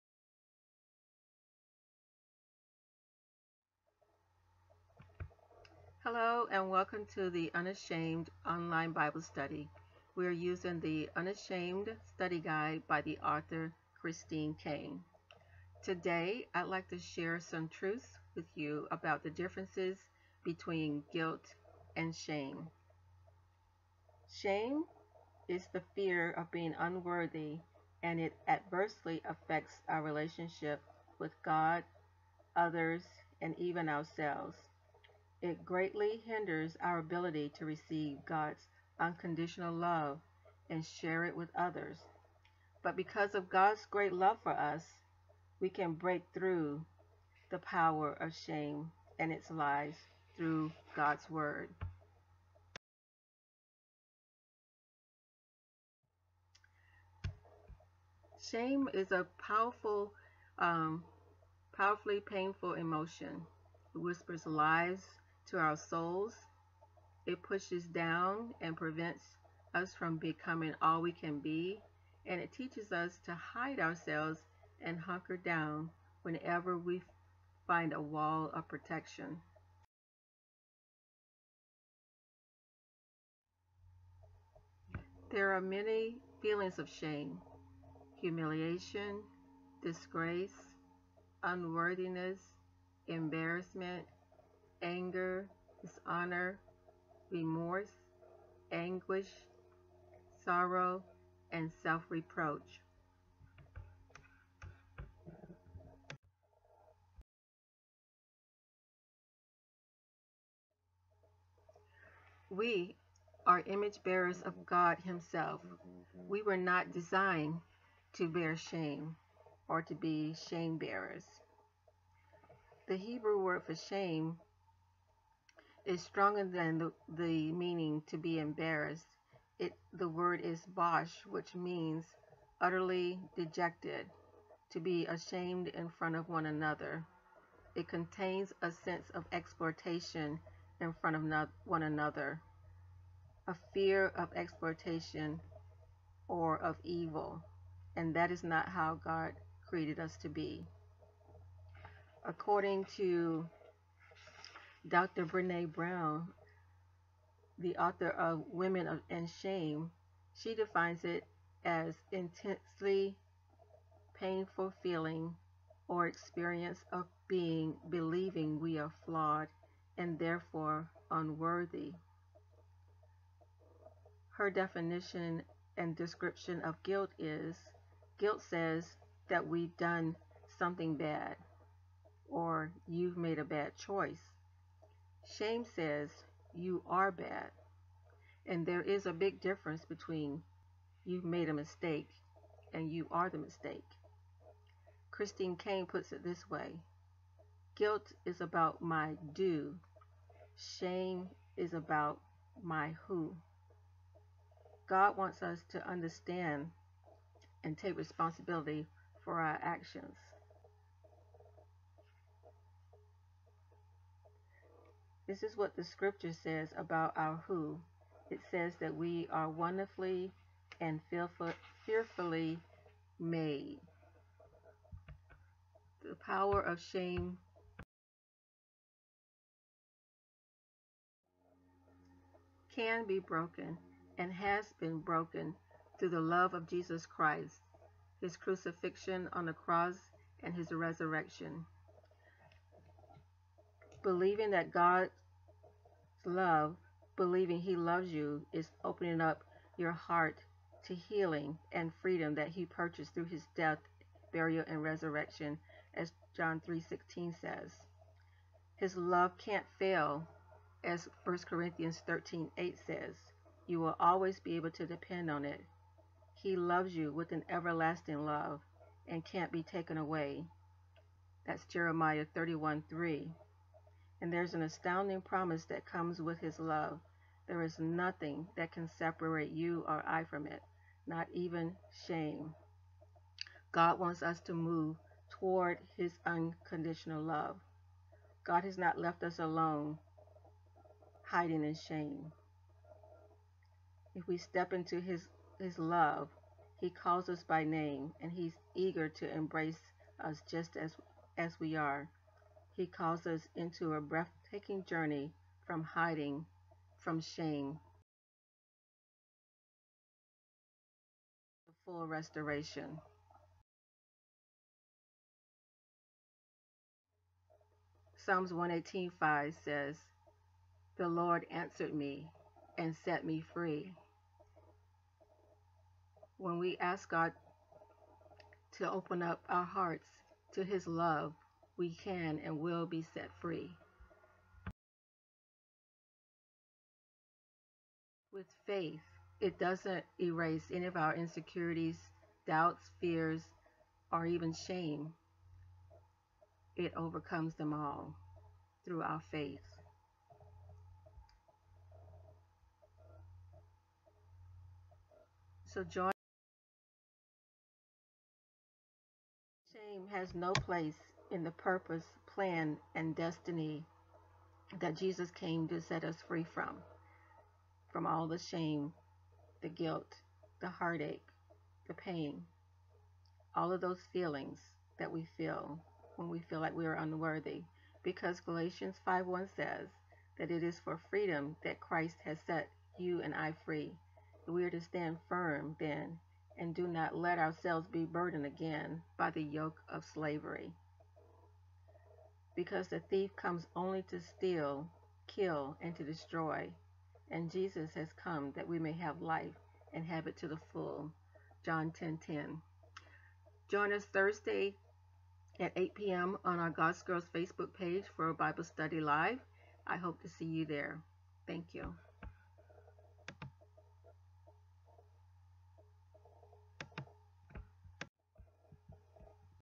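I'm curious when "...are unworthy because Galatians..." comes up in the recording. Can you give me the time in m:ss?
6:16.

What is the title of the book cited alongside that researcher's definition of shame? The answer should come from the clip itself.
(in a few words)
Women and Shame.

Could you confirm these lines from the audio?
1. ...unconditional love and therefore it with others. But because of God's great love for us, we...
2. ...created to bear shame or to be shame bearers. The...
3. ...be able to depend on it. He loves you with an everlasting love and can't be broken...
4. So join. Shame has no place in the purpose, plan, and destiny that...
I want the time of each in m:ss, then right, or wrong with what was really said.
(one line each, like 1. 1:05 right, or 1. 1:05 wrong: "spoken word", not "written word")
1. 0:38 wrong: "share", not "therefore"
2. 1:56 wrong: "designed", not "created"
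3. 4:24 wrong: "taken", not "broken"
4. 5:55 right.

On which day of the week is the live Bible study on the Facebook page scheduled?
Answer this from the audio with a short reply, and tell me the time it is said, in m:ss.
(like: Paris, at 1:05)
Thursday, at 6:44.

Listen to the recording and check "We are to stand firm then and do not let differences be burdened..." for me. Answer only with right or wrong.
wrong.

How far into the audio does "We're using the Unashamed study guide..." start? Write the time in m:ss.
0:10.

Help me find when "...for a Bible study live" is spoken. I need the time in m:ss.
6:48.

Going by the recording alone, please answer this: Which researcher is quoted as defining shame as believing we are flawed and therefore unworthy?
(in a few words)
Brene Brown.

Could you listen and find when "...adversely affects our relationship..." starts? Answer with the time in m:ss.
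0:28.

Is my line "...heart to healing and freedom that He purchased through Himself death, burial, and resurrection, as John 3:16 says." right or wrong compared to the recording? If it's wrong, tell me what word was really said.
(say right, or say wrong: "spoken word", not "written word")
wrong: "His", not "Himself".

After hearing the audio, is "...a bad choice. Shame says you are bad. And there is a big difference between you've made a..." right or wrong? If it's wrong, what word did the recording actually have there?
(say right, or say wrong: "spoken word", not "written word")
right.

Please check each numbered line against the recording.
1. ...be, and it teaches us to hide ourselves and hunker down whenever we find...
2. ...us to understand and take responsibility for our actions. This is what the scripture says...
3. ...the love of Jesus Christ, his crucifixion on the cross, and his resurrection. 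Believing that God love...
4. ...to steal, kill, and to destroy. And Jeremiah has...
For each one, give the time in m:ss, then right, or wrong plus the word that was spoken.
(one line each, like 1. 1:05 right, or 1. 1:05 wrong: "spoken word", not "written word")
1. 1:11 right
2. 3:25 right
3. 3:56 right
4. 6:34 wrong: "Jesus", not "Jeremiah".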